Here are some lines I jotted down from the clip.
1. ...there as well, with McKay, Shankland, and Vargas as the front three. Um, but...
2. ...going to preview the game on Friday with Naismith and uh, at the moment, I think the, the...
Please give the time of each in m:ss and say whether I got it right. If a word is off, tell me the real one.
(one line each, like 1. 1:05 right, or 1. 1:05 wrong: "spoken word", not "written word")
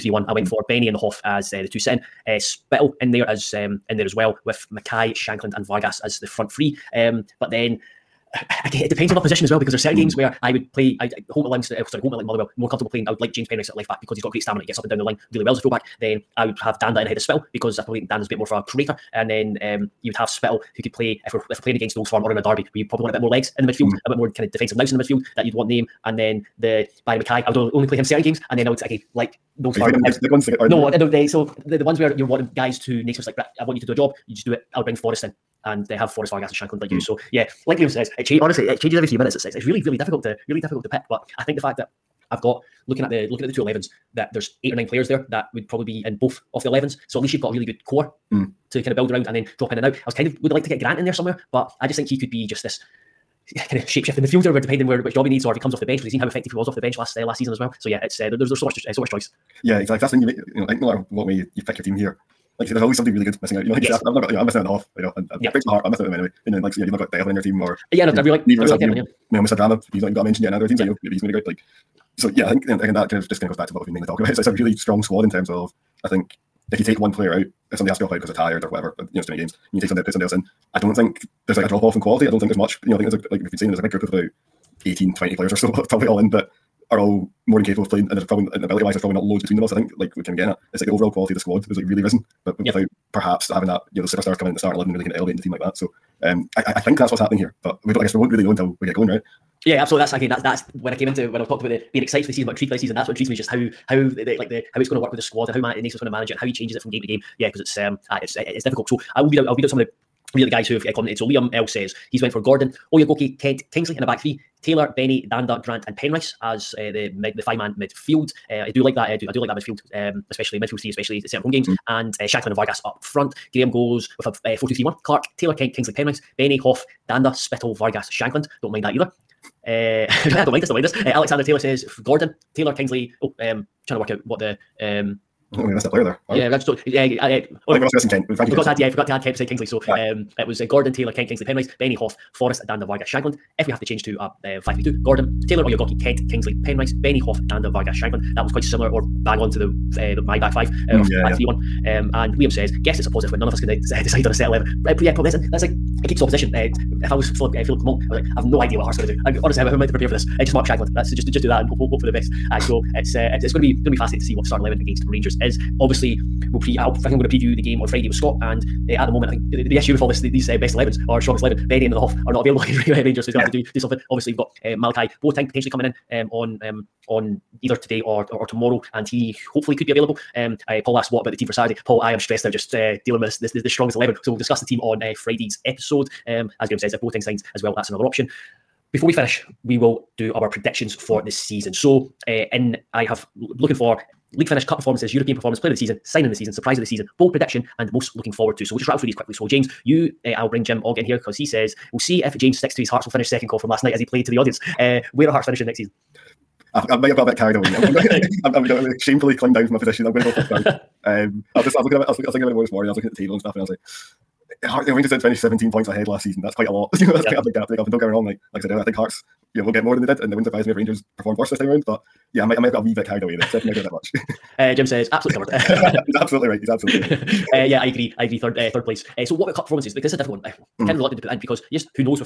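1. 0:03 right
2. 2:47 wrong: "Scott", not "Naismith".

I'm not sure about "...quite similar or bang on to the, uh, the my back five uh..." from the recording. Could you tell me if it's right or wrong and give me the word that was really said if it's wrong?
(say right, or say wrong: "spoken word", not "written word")
right.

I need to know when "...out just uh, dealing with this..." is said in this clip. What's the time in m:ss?
3:02.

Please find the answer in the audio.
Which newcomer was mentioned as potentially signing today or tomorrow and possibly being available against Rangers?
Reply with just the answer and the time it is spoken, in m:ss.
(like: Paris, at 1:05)
Malachi Boateng, at 2:54.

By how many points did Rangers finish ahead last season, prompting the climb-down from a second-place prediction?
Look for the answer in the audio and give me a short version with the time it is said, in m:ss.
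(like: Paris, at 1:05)
17, at 3:35.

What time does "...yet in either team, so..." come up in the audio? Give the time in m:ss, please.
1:10.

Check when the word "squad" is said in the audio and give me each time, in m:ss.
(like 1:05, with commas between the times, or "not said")
1:15, 1:31, 1:45.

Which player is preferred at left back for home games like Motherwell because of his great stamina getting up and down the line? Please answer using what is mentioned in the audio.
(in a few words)
James Penrice.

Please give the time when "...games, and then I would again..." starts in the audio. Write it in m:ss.
0:28.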